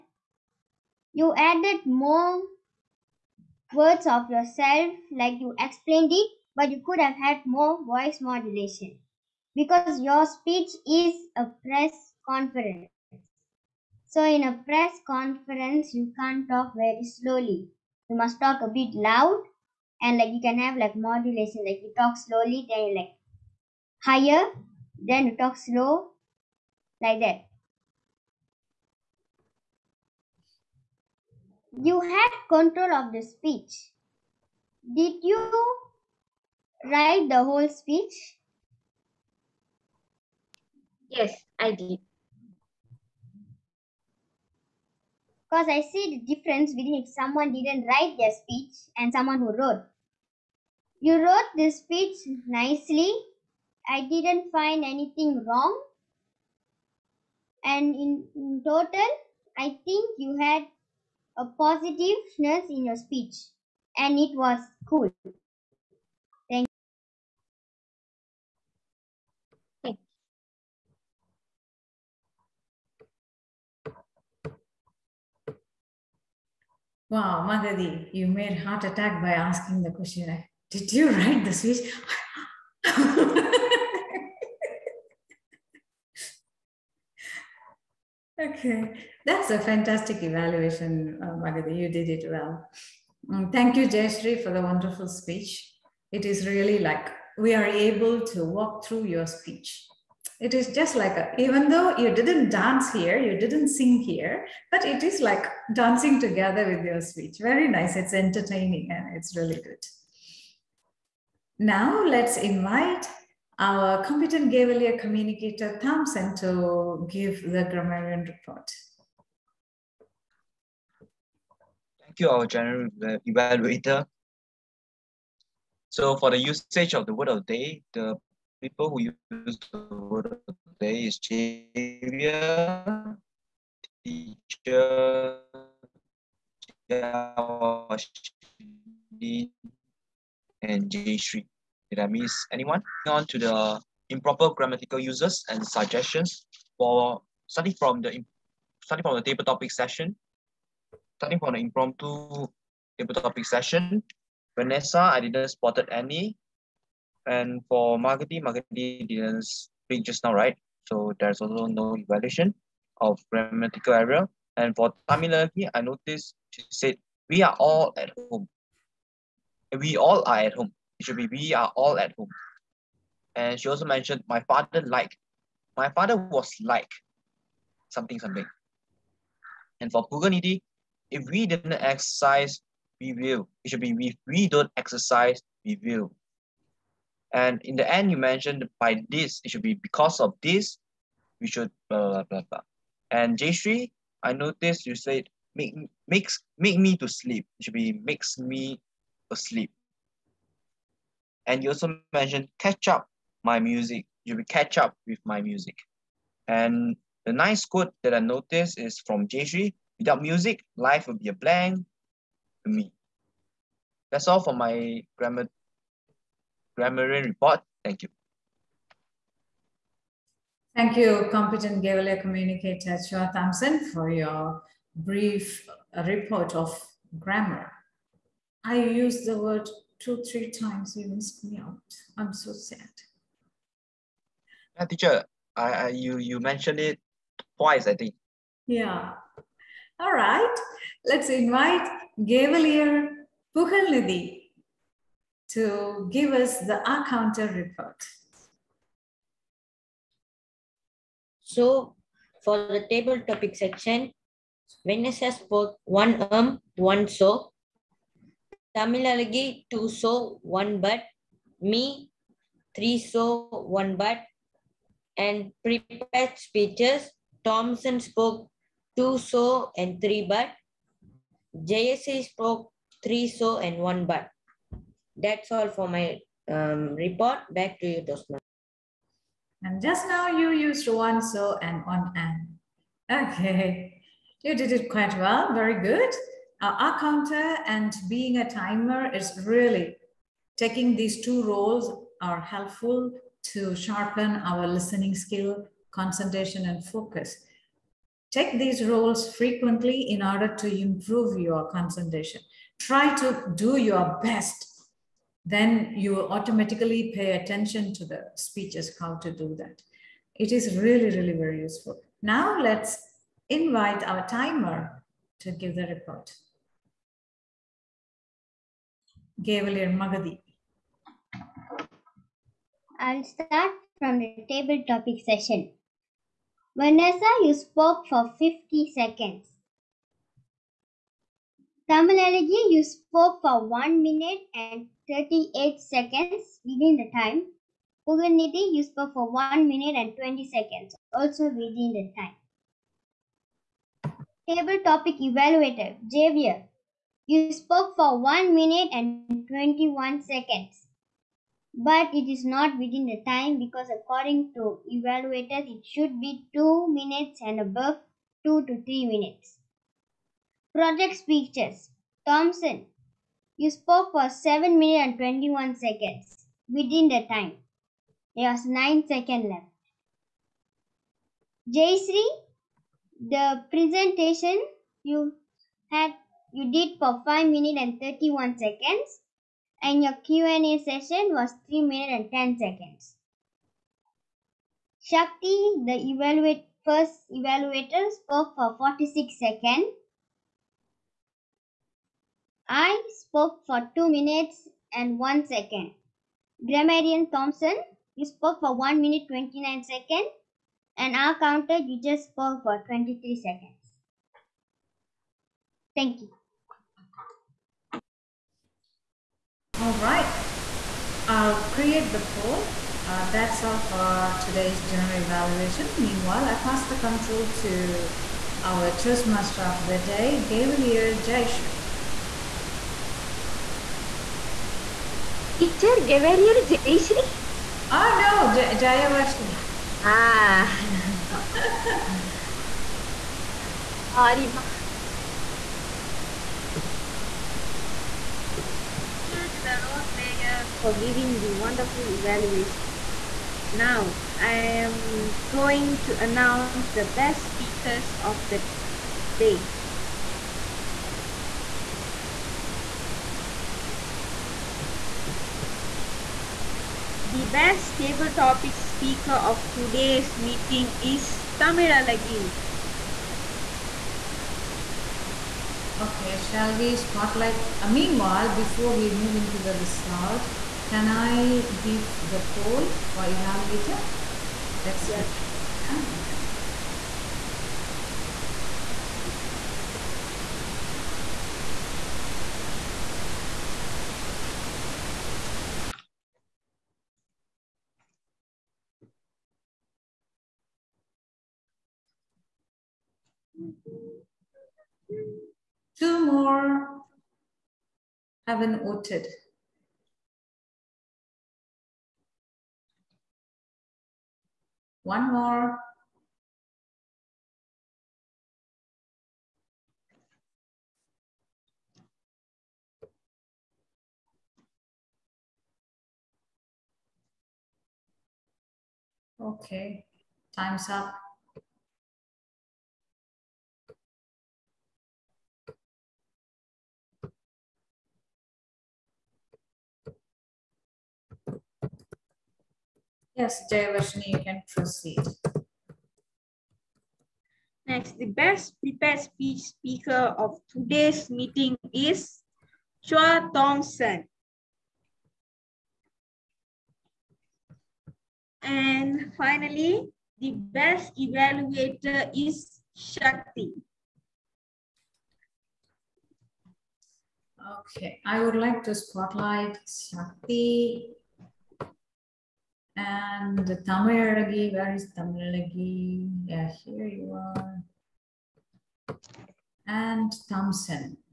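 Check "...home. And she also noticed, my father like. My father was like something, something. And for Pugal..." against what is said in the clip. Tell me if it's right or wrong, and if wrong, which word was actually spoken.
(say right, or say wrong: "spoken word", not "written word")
wrong: "mentioned", not "noticed".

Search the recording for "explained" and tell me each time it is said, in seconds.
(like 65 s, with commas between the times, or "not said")
5 s.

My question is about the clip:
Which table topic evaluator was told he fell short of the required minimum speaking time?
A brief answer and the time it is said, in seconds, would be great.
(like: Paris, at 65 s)
Javier, at 346 s.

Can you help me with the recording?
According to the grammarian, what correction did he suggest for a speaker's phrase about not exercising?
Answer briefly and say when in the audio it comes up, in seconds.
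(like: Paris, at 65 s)
if we don't exercise, at 183 s.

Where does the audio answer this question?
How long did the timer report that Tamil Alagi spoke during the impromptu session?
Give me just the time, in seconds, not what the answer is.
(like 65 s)
333 s.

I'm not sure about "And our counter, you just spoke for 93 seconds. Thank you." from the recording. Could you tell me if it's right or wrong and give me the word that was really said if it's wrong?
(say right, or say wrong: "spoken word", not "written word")
wrong: "23", not "93".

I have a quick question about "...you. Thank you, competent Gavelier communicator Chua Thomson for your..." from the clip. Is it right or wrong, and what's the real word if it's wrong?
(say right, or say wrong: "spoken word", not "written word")
right.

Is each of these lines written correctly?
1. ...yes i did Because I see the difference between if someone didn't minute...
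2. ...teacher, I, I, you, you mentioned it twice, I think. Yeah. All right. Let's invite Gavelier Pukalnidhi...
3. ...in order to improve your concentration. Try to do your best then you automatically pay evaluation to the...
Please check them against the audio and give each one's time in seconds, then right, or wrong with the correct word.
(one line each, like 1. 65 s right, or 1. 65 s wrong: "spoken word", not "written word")
1. 41 s wrong: "write", not "minute"
2. 234 s right
3. 300 s wrong: "attention", not "evaluation".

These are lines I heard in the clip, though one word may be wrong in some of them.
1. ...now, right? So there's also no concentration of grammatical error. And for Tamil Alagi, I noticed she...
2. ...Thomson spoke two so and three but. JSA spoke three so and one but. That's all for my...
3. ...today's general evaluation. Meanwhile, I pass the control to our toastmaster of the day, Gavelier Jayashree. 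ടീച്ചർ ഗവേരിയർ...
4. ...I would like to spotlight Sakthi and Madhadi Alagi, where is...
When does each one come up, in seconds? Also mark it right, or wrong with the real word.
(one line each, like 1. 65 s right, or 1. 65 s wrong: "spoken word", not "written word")
1. 160 s wrong: "evaluation", not "concentration"
2. 267 s right
3. 414 s right
4. 558 s wrong: "Tamil", not "Madhadi".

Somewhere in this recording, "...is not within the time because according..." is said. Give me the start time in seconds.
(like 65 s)
352 s.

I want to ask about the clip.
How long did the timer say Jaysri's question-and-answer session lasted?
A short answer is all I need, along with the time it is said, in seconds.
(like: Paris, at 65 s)
3 minutes 10 seconds, at 381 s.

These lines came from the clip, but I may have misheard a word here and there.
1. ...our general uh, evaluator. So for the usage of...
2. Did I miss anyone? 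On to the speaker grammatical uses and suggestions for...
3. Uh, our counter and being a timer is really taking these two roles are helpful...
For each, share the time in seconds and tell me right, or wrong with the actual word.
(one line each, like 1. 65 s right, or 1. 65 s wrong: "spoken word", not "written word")
1. 122 s right
2. 141 s wrong: "improper", not "speaker"
3. 286 s right.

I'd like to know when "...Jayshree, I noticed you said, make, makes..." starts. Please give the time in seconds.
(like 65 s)
193 s.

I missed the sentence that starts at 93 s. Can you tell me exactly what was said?
Um, thank you, Jayashree, for the wonderful speech.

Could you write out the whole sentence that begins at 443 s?
Now, I am going to announce the best speakers of the day.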